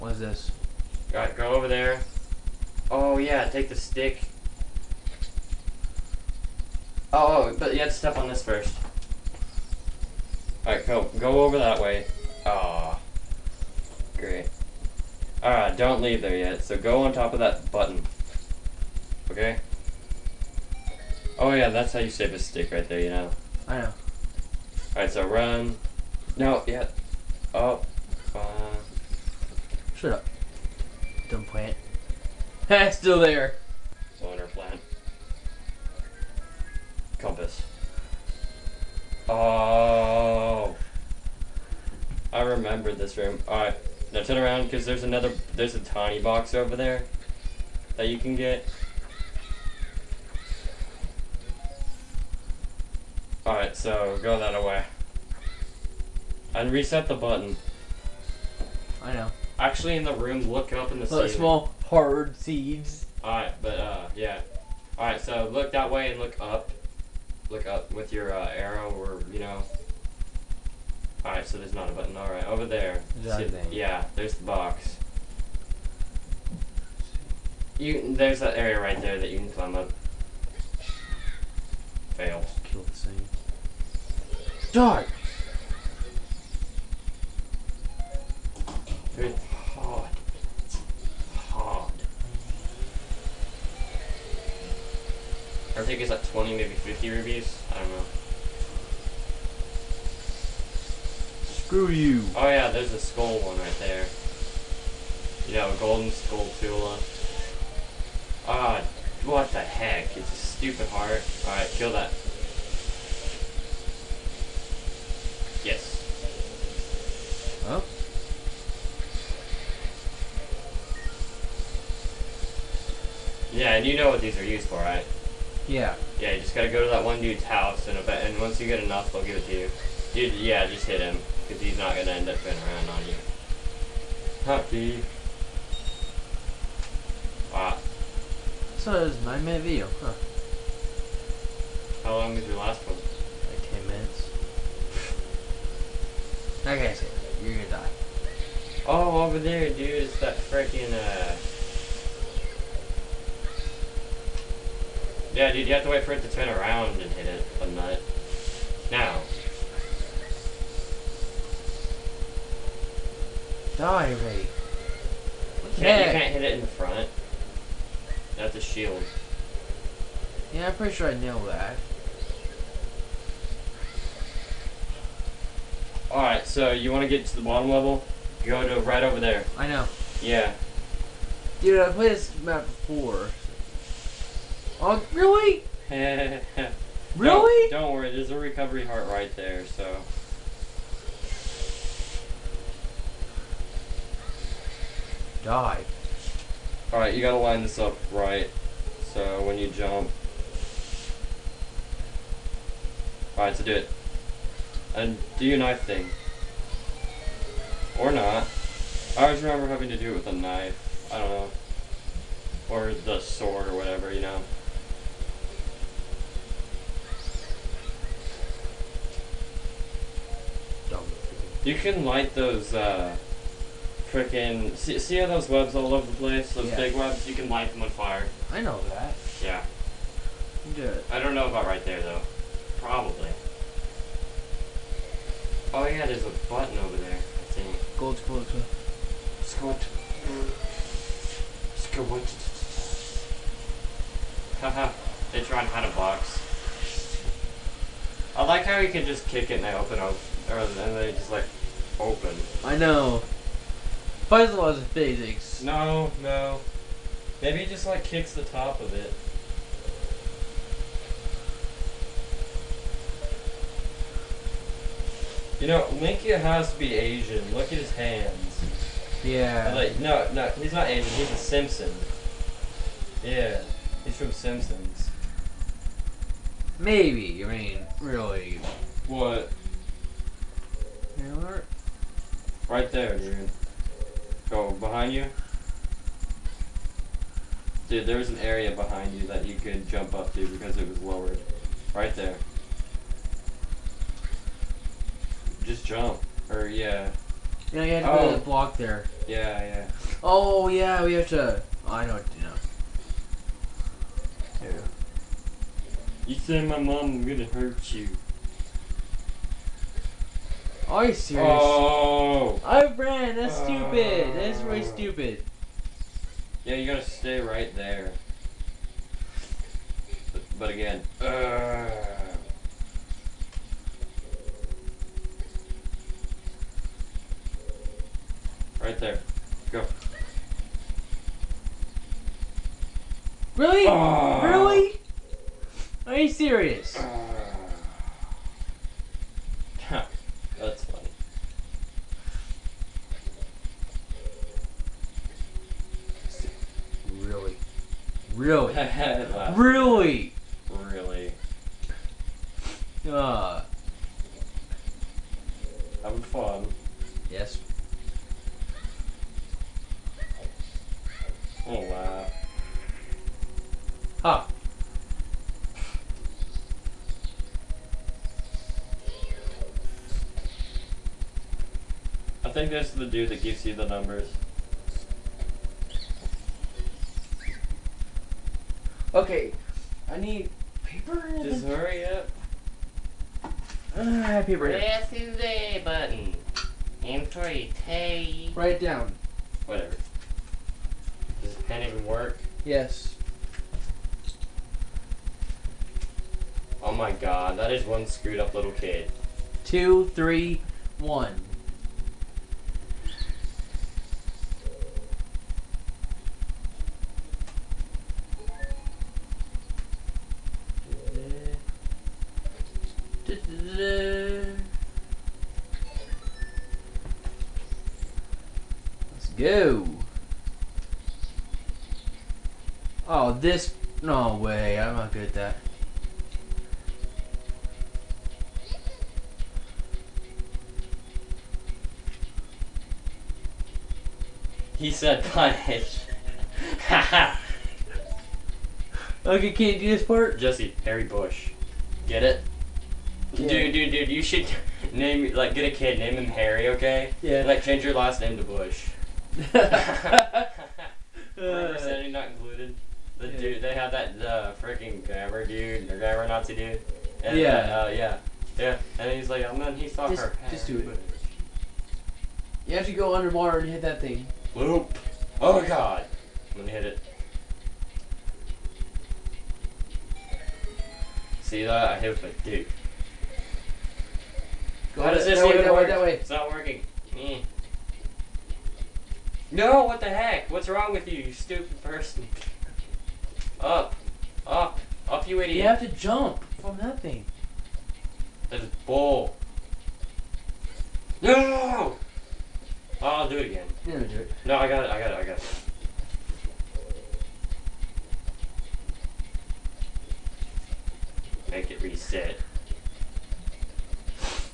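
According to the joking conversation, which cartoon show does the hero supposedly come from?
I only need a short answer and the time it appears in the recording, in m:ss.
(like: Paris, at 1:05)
Simpsons, at 4:34.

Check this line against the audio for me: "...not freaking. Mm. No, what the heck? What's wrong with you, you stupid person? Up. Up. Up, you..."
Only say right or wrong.
wrong.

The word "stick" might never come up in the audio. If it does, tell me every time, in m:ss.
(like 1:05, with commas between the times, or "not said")
0:03, 0:22.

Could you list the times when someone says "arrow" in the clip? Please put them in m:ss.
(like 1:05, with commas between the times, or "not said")
1:08.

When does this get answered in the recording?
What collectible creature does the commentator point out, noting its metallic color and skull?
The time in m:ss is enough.
1:45.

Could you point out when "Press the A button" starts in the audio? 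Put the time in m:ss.
6:24.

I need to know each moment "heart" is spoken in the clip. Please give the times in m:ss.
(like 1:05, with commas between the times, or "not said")
1:50, 3:08.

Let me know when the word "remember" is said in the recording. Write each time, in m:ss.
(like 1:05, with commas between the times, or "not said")
0:42, 3:29, 7:29.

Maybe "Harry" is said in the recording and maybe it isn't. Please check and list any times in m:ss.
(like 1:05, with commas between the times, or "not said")
7:20, 7:26.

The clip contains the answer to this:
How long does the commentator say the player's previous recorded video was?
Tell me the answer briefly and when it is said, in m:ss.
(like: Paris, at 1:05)
10 minutes, at 2:23.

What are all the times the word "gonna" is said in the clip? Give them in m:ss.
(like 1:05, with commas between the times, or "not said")
2:27, 5:07, 7:39, 7:46.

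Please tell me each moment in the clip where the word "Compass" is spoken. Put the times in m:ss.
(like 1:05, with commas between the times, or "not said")
0:37.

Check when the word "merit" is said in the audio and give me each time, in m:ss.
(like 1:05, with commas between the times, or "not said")
not said.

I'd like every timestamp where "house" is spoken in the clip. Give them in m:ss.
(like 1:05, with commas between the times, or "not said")
2:07.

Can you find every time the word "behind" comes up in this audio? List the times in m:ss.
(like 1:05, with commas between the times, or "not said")
4:44, 4:48.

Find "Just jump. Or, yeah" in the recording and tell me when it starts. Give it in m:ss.
4:55.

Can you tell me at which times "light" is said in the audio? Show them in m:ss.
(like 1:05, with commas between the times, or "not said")
3:42, 3:47.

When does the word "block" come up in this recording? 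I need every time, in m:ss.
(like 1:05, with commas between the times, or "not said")
4:58.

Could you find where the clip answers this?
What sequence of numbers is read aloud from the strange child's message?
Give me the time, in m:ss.
6:39.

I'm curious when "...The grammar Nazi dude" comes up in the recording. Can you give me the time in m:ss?
7:35.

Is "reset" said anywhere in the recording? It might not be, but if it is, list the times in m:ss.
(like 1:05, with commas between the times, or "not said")
0:56, 8:21.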